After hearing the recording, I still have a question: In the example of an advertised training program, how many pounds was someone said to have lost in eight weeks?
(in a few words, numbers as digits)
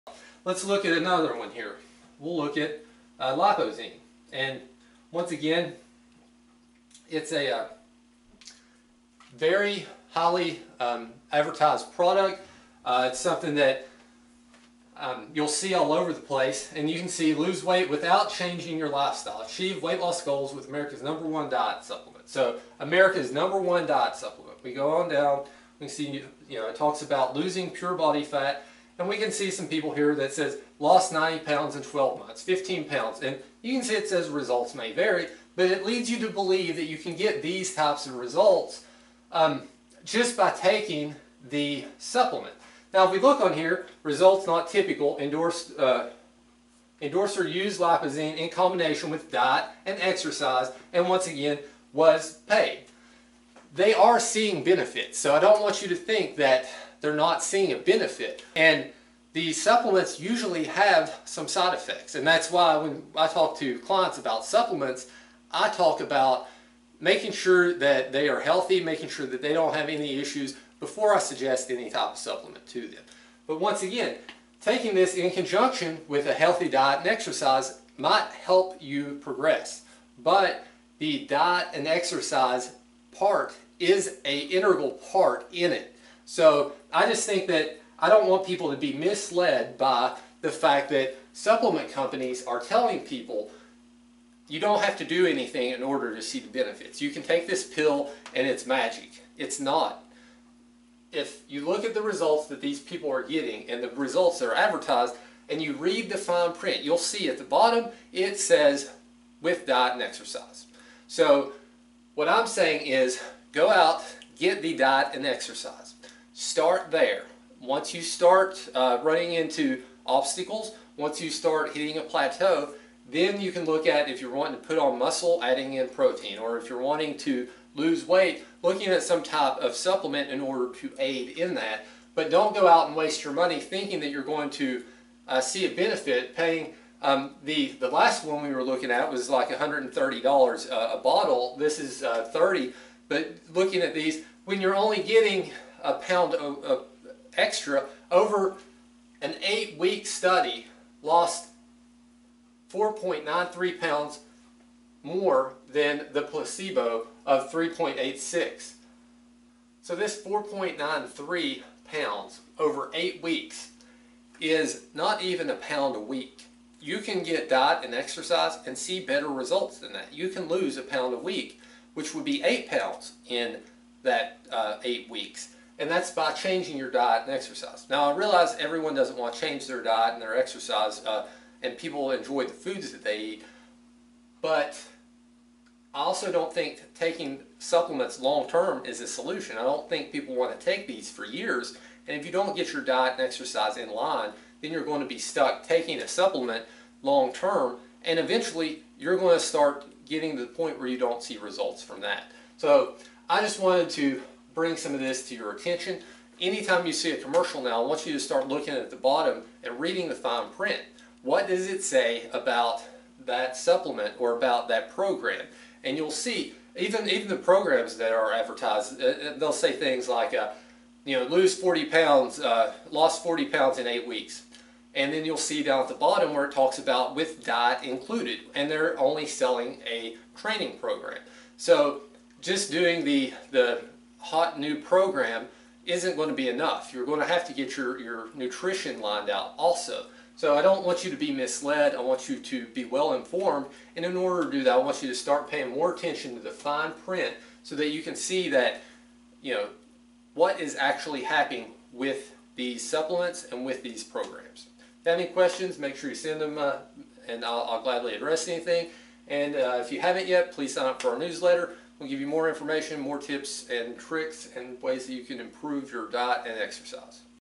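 40 pounds.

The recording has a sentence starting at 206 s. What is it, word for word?
Anytime you see a commercial now, I want you to start looking at the bottom and reading the fine print.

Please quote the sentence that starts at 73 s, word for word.
But once again, taking this in conjunction with a healthy diet and exercise might help you progress.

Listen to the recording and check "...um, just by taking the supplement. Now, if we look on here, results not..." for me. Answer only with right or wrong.
right.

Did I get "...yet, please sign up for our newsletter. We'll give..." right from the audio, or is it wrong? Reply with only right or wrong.
right.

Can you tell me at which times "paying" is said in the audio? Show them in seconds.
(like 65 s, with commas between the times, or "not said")
136 s, 245 s.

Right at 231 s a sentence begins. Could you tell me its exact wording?
So just doing the, the hot new program isn't going to be enough.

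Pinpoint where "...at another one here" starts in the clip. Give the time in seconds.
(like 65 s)
0 s.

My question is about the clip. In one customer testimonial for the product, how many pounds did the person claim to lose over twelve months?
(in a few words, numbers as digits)
90 pounds.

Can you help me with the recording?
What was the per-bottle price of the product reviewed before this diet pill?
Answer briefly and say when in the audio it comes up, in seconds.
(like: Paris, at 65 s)
$130, at 139 s.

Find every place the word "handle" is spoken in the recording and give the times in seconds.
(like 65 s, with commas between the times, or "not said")
not said.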